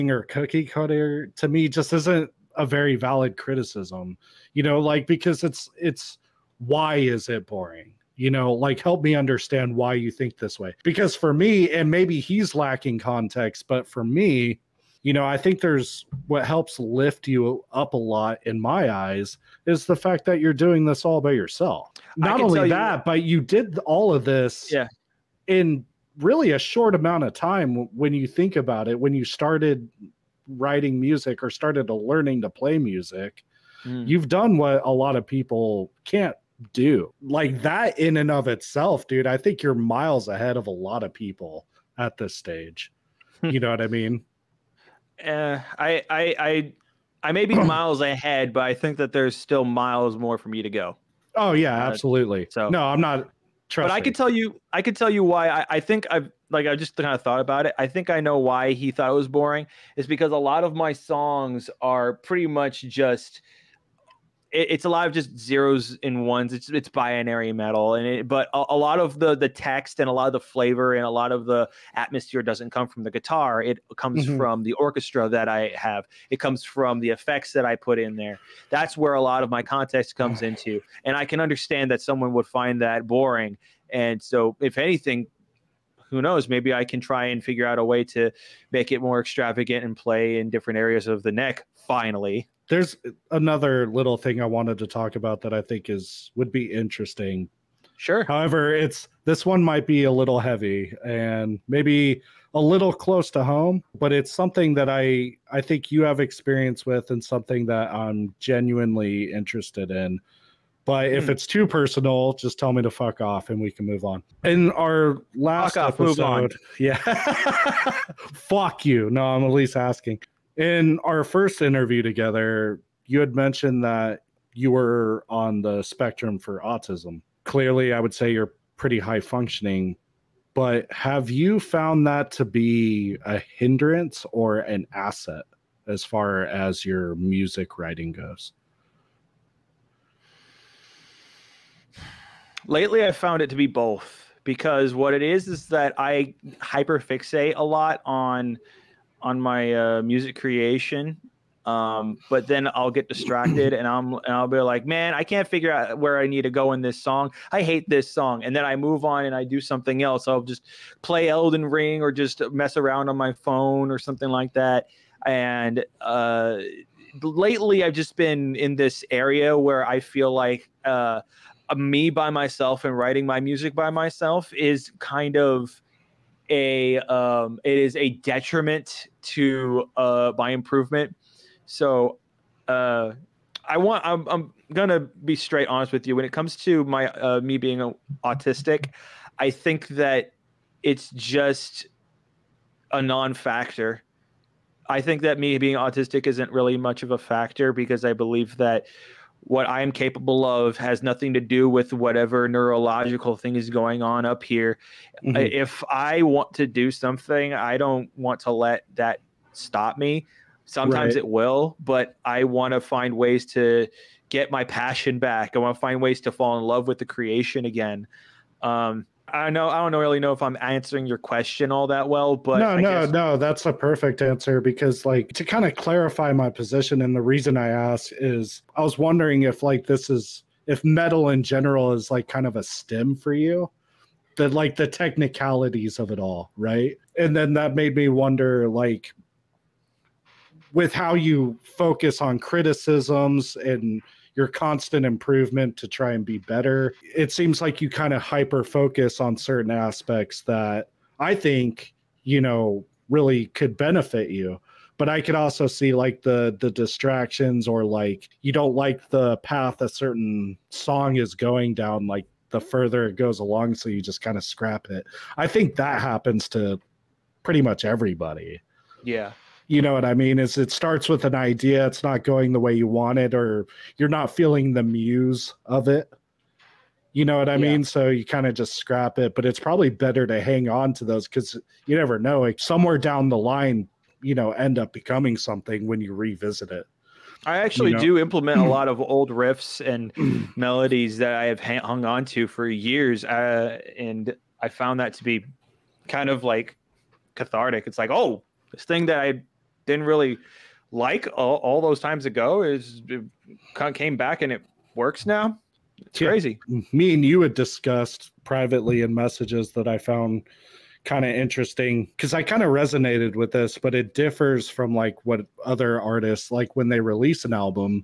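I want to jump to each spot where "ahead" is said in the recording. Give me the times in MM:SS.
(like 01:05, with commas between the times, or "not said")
00:40, 00:48.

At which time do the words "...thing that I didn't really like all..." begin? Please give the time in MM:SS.
04:58.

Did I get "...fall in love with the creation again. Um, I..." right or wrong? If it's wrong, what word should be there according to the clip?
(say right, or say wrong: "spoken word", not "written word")
right.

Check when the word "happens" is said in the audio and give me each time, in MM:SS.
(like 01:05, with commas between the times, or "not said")
04:25.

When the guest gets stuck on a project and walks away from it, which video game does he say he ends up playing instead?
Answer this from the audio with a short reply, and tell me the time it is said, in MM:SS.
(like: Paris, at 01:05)
Elden Ring, at 02:41.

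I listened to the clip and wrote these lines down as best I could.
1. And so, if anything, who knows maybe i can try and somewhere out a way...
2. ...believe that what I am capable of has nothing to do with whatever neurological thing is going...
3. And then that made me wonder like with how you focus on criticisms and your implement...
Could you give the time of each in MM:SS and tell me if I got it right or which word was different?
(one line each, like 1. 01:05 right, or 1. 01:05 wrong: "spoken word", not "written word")
1. 01:23 wrong: "figure", not "somewhere"
2. 03:18 right
3. 03:57 wrong: "constant", not "implement".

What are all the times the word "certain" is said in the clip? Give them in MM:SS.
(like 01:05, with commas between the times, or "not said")
04:09, 04:19.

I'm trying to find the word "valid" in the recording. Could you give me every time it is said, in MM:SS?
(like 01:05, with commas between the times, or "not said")
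00:02.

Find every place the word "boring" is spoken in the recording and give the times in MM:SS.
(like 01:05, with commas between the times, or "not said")
00:07, 00:59, 01:23.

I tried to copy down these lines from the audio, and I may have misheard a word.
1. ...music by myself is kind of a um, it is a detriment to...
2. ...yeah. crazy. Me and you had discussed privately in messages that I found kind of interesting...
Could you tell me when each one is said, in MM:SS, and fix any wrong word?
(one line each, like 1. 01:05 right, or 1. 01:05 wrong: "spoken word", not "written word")
1. 02:53 right
2. 05:06 right.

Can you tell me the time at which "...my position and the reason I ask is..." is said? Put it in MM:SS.
03:46.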